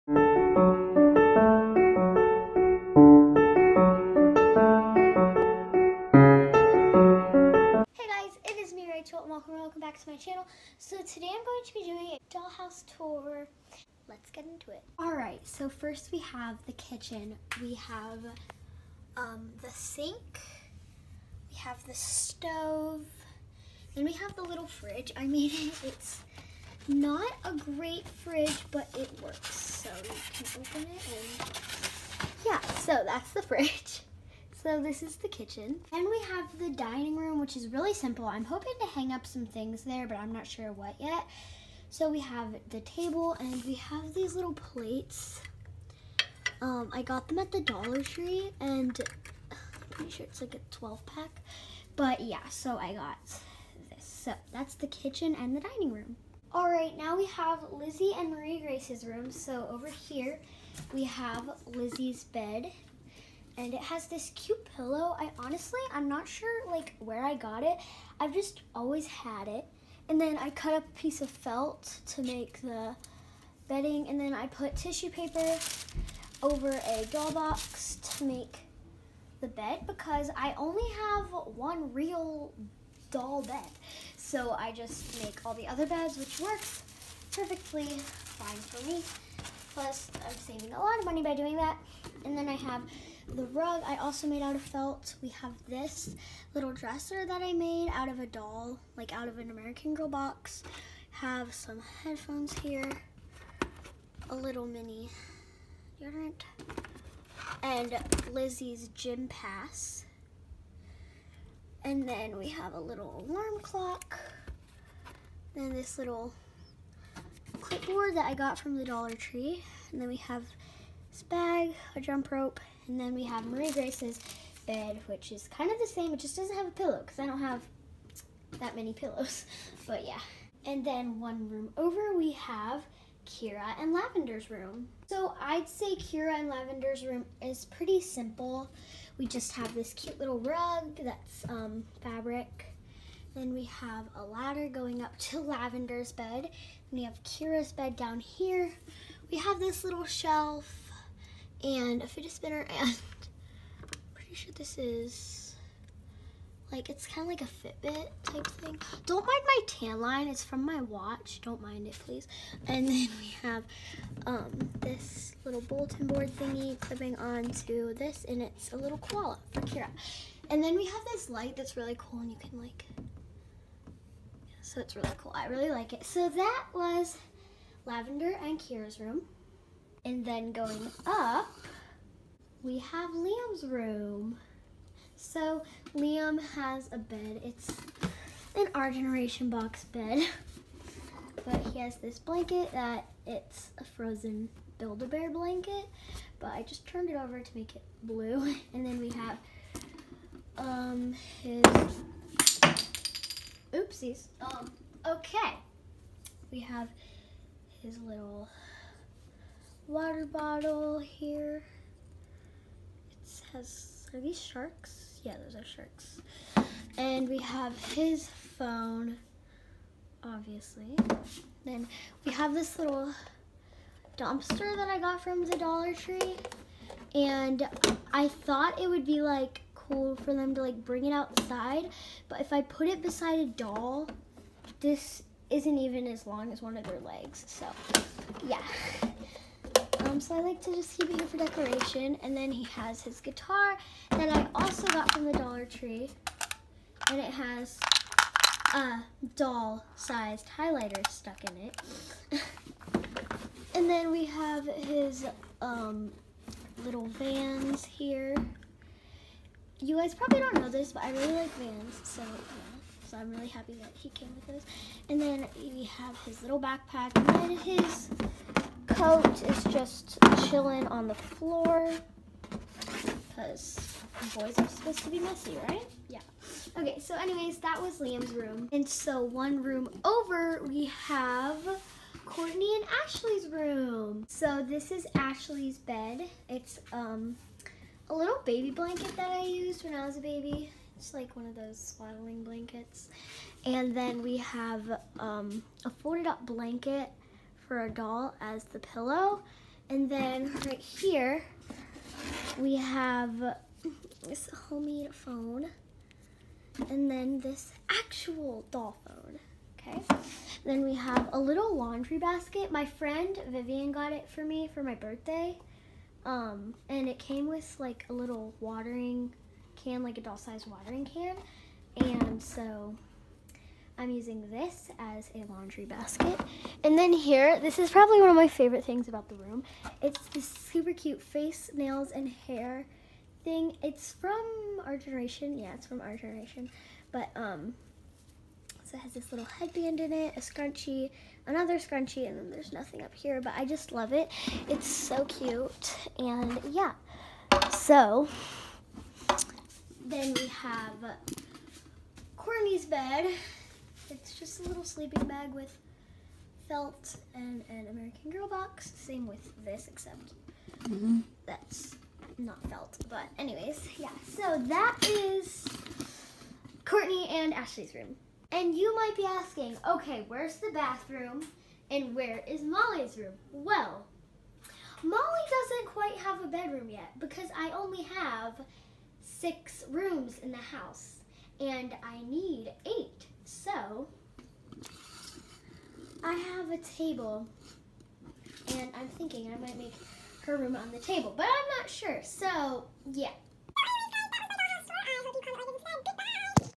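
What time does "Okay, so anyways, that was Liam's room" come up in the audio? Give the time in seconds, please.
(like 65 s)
276 s.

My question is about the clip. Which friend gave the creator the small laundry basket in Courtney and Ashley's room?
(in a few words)
Vivian.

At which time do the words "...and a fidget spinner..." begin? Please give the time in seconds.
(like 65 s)
151 s.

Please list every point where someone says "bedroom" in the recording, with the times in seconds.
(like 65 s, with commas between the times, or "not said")
376 s.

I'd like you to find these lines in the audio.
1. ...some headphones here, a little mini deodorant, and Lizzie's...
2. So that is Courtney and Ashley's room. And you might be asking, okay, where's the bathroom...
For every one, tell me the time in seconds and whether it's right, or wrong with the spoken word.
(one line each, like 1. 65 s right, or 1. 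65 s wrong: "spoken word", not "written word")
1. 101 s right
2. 364 s right.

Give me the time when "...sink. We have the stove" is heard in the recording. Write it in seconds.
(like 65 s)
19 s.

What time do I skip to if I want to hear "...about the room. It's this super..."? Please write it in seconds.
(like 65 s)
329 s.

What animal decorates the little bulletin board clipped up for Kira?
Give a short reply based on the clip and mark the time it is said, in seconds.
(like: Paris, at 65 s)
Koala, at 168 s.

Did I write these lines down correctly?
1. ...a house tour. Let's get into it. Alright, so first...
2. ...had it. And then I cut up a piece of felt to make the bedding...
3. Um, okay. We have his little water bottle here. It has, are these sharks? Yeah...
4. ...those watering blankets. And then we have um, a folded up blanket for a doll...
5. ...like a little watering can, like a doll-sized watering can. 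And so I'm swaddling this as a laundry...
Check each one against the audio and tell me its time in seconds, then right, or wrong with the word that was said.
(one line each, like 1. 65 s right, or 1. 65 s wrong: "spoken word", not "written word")
1. 12 s wrong: "dollhouse", not "house"
2. 69 s right
3. 204 s right
4. 291 s wrong: "swaddling", not "watering"
5. 317 s wrong: "using", not "swaddling".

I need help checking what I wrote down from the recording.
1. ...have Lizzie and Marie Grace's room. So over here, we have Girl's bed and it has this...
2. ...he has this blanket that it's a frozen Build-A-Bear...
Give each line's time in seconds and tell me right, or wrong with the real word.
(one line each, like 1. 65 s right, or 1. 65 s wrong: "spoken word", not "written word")
1. 57 s wrong: "Lizzie", not "Girl"
2. 191 s right.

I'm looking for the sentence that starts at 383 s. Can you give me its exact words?
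So, I have a table, and I'm thinking I might make her room on the table, but I'm not sure.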